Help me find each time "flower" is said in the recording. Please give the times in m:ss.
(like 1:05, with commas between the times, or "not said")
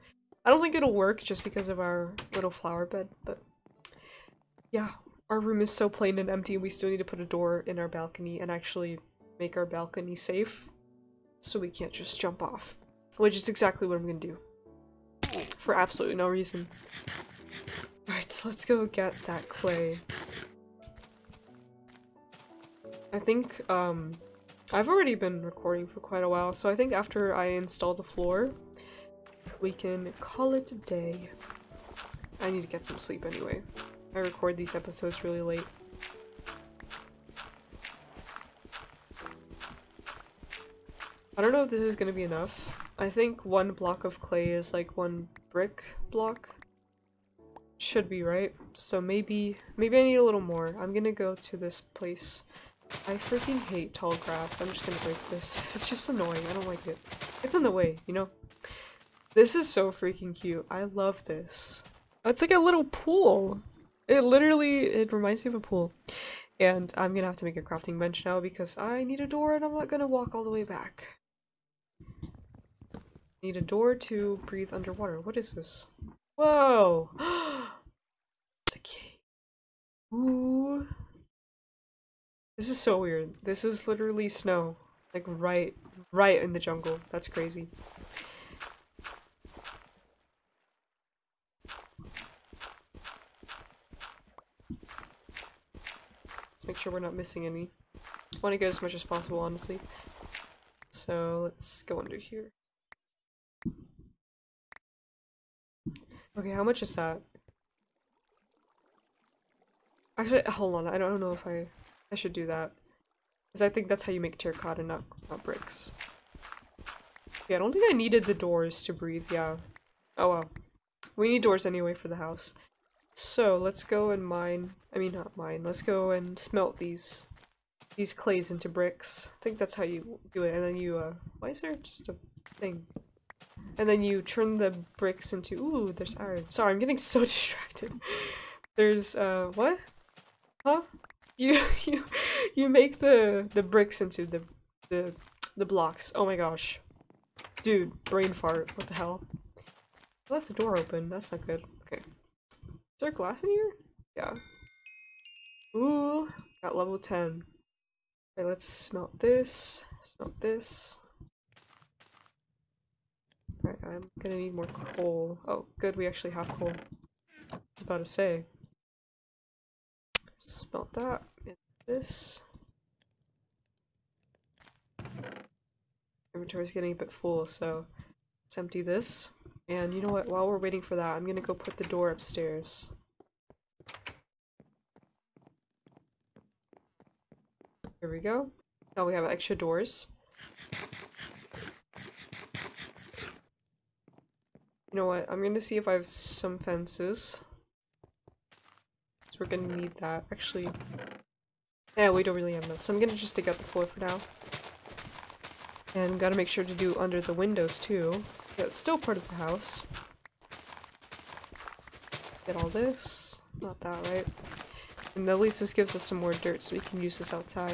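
0:02.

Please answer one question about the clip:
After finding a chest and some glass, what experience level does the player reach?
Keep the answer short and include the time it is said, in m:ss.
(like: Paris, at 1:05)
10, at 2:36.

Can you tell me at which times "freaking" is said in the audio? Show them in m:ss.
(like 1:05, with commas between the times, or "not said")
0:53, 0:59.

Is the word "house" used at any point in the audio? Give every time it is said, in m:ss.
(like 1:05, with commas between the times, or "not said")
2:02, 3:29.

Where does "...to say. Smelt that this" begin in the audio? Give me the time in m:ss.
2:47.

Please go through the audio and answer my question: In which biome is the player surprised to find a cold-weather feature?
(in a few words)
jungle.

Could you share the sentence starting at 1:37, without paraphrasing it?
I want to get as much as possible, honestly.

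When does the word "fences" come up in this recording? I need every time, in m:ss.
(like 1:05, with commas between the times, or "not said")
3:16.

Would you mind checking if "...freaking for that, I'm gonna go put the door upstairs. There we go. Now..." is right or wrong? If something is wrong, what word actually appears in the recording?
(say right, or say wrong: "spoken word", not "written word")
wrong: "waiting", not "freaking".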